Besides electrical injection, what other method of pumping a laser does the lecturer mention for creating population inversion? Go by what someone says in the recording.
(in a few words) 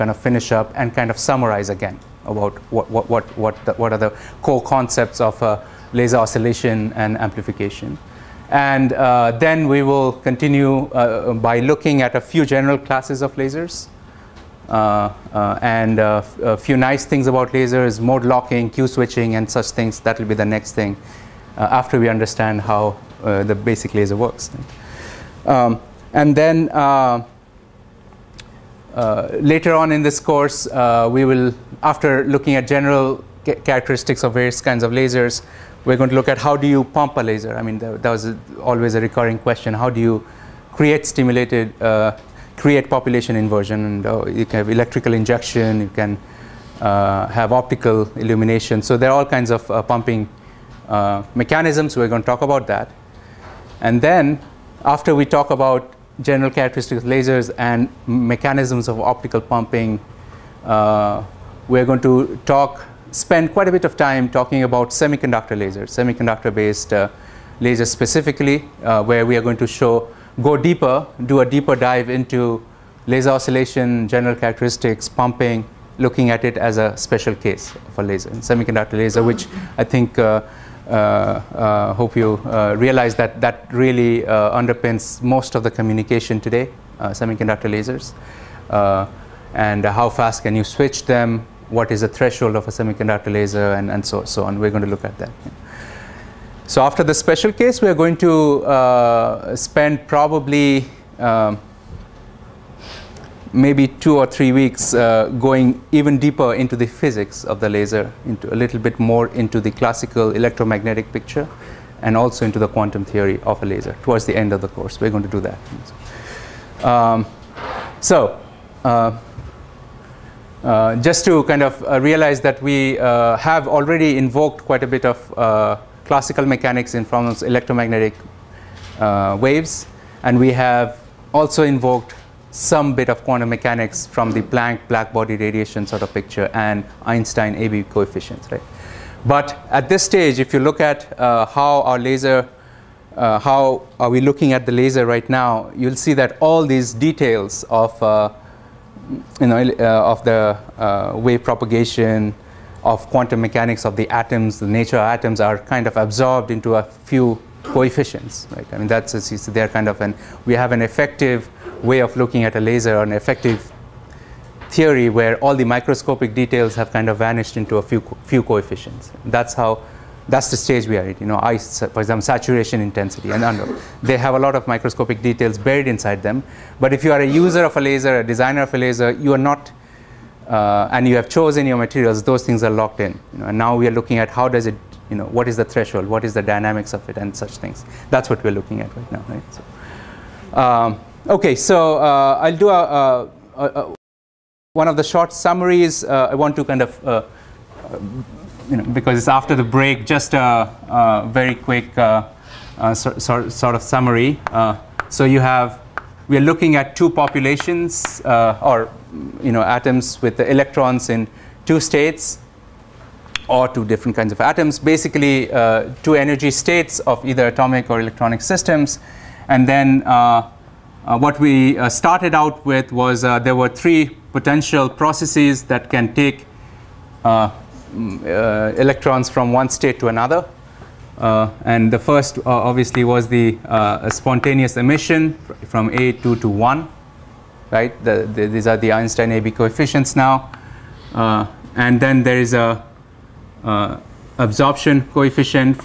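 optical illumination.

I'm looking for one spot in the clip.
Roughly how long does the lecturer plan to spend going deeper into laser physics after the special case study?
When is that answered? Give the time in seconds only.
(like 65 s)
103 s.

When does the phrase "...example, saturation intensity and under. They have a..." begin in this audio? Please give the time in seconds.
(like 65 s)
172 s.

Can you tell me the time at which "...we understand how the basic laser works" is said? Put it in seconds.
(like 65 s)
21 s.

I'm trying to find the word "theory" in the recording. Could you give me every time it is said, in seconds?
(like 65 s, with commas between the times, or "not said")
113 s, 164 s.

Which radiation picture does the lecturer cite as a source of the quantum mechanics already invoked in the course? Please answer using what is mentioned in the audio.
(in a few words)
Planck black body radiation.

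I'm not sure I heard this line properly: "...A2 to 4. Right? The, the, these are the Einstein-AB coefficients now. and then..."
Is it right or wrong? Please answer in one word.
wrong.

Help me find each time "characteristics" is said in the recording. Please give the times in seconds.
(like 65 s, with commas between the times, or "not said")
33 s, 56 s, 74 s.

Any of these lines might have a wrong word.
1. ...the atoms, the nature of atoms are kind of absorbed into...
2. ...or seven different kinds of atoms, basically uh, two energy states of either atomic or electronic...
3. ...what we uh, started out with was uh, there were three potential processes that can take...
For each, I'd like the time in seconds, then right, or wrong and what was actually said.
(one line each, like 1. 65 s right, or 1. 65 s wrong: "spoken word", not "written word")
1. 153 s right
2. 213 s wrong: "two", not "seven"
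3. 221 s right.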